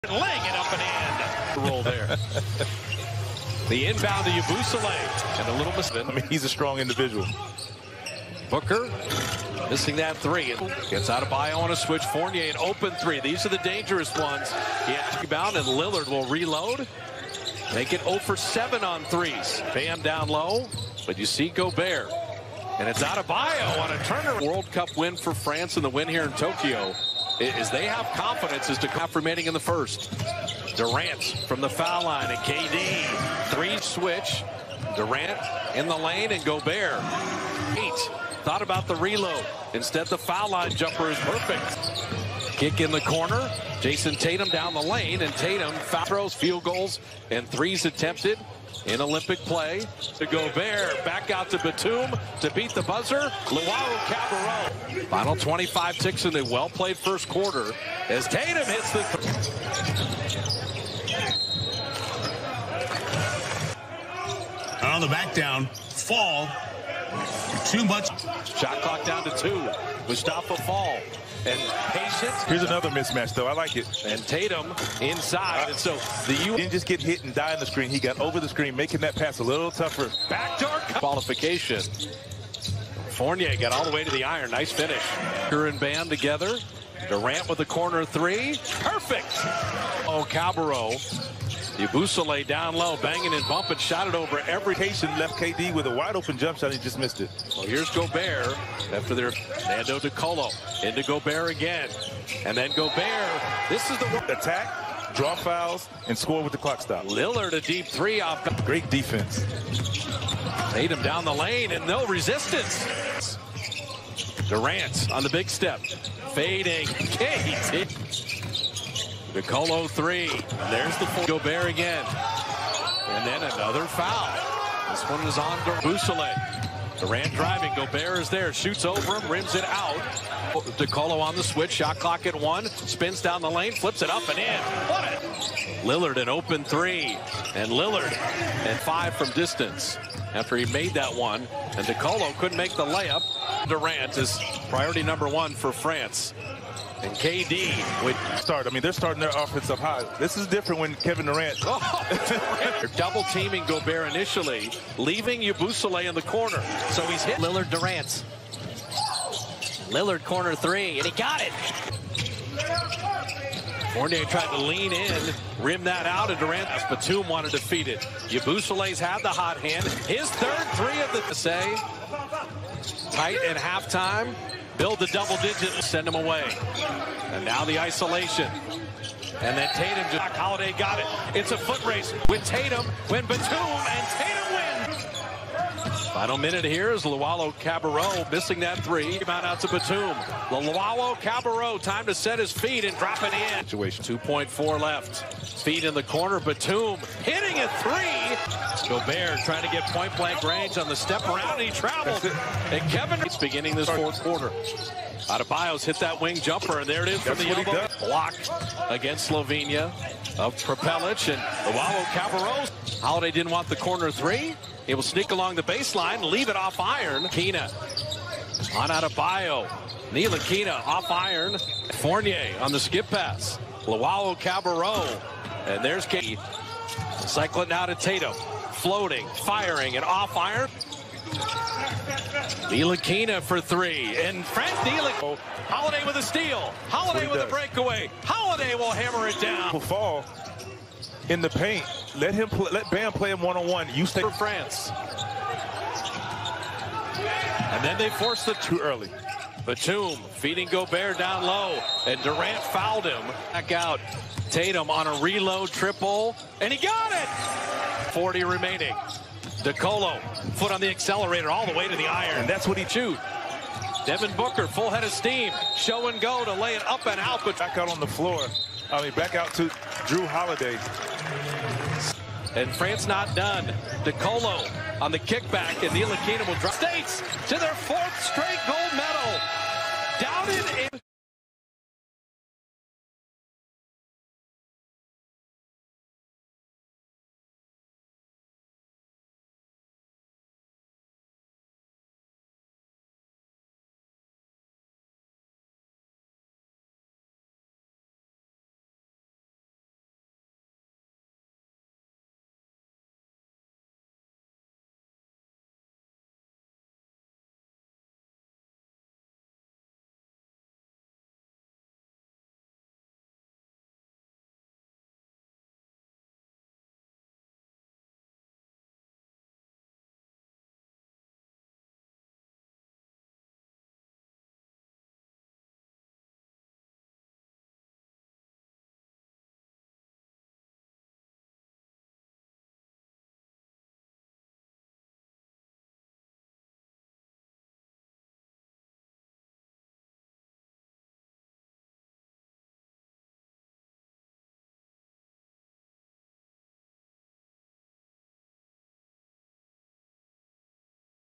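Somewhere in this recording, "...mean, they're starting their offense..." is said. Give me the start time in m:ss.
2:28.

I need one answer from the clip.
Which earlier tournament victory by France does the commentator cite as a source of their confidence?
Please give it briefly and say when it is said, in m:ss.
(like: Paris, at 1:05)
World Cup, at 0:24.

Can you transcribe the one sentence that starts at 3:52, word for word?
Ntilikina for three, and Fred Ntilikina.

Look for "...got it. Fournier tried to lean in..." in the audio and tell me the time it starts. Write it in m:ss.
2:41.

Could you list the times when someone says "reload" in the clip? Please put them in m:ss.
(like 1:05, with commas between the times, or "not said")
0:16, 0:38, 4:15.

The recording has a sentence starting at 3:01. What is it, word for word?
It's a foot race with Tatum, when Batum, and Tatum wins.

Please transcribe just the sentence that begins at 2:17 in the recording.
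And Lillard and five from distance after he made that one.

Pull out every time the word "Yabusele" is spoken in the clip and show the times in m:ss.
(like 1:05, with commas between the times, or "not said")
0:04, 1:31, 2:05, 2:35, 2:48.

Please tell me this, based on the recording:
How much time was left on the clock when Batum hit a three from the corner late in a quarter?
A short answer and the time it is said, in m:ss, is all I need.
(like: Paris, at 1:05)
2.4 seconds, at 3:14.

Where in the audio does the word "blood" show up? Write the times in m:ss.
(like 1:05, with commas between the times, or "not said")
not said.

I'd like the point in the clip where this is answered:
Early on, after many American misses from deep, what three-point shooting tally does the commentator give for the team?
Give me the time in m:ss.
0:18.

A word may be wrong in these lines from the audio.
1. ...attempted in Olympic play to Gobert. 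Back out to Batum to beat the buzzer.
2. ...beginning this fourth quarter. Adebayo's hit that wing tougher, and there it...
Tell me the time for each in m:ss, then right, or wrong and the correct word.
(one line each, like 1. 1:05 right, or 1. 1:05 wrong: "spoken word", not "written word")
1. 0:47 right
2. 3:23 wrong: "jumper", not "tougher".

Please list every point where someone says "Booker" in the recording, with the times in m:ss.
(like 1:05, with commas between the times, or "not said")
0:08, 4:24.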